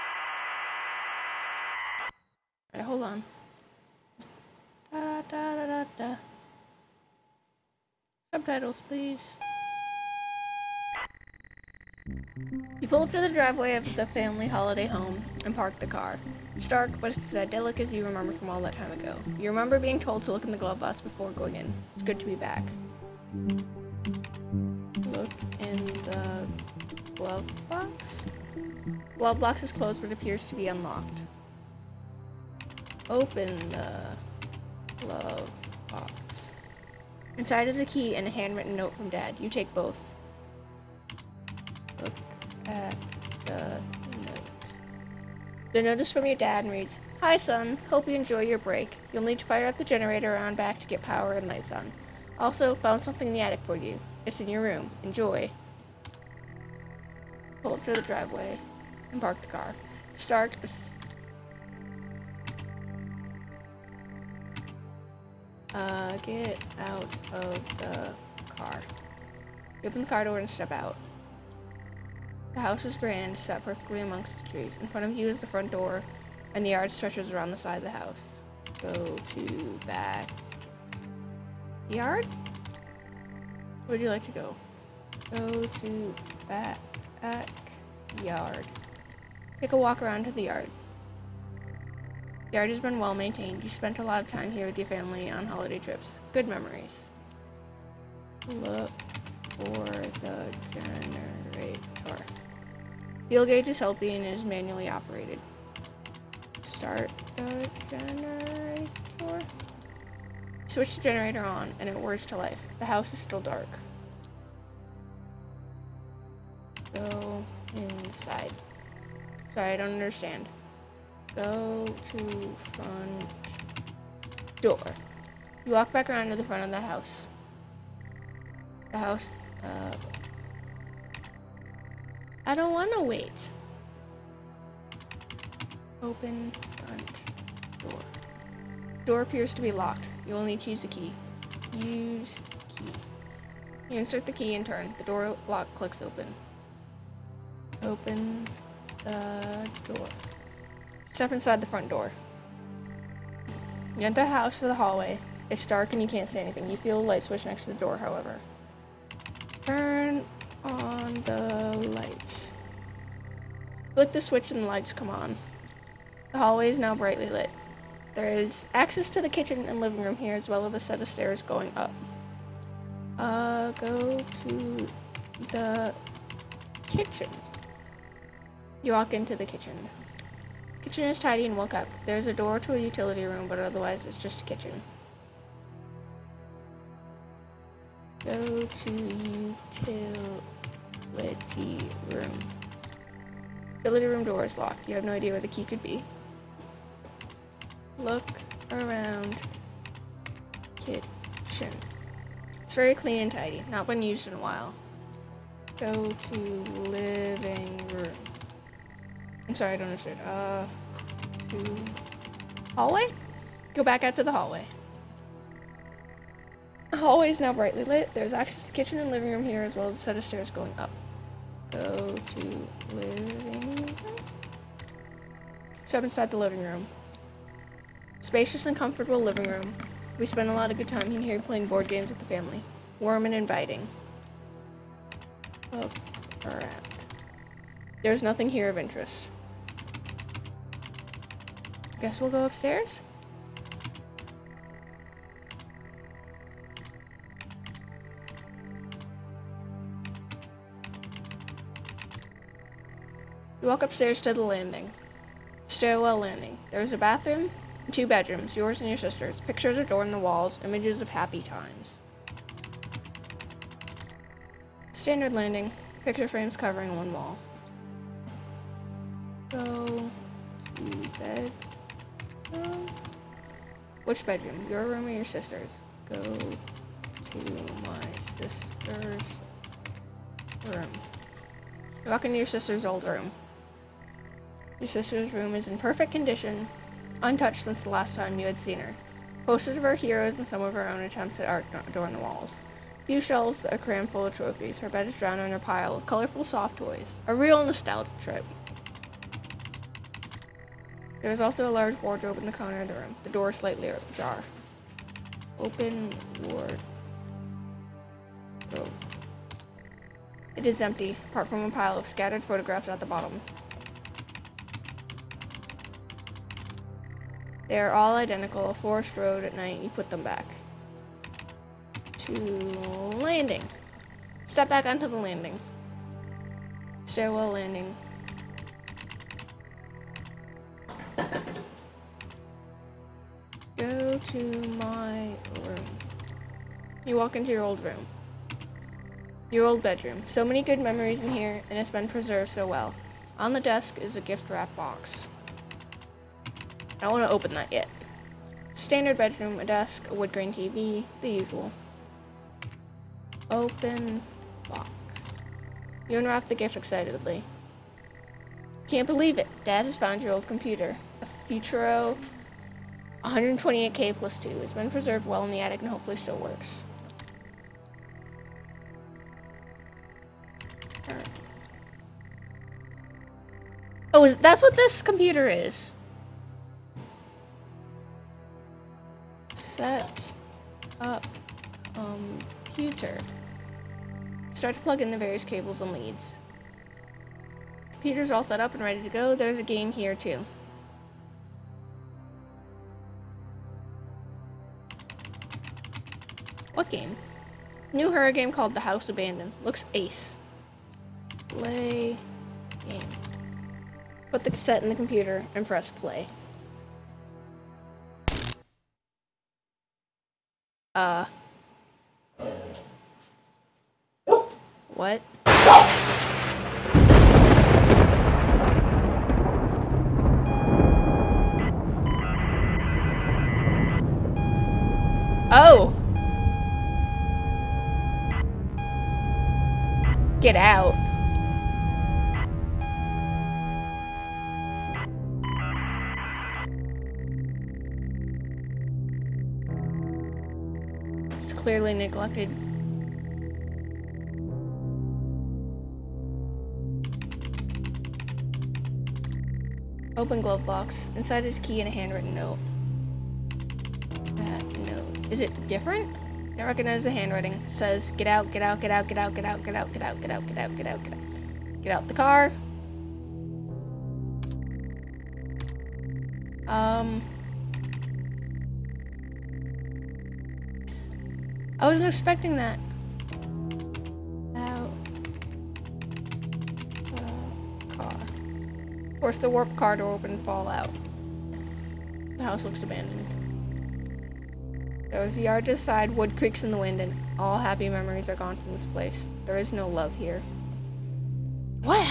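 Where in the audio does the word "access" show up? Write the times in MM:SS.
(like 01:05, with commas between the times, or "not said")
02:48, 03:38.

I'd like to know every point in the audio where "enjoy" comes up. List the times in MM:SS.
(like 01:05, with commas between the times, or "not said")
00:48, 00:55.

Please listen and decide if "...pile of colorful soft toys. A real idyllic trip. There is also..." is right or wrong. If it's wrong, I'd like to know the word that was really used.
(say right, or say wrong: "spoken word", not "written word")
wrong: "nostalgic", not "idyllic".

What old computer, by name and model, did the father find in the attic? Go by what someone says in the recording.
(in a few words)
Futuro 128k plus 2.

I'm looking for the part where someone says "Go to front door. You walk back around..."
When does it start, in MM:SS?
02:01.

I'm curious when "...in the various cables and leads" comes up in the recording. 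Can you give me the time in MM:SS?
06:24.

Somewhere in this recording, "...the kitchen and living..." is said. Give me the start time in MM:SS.
02:49.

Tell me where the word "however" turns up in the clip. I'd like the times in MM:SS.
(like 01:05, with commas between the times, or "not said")
02:37.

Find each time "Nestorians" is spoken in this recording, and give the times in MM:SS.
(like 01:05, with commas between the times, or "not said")
not said.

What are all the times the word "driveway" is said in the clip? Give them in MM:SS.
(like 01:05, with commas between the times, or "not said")
00:13, 00:58.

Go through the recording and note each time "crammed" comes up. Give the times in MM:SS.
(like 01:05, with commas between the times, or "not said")
04:53.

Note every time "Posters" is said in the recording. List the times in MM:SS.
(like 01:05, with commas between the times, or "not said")
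04:49.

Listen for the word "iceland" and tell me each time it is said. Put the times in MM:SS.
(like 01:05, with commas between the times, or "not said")
not said.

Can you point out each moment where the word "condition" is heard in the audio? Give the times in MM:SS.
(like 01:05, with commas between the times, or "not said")
04:46.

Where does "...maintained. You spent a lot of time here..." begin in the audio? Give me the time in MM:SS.
01:33.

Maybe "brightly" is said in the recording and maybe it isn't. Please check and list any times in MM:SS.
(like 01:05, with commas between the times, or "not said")
02:46, 03:37.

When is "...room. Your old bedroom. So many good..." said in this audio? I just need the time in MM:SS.
05:37.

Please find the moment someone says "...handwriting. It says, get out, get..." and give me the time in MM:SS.
07:37.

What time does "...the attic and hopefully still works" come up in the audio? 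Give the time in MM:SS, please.
06:05.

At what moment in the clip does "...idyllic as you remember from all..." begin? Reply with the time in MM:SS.
00:17.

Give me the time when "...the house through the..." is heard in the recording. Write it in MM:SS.
02:34.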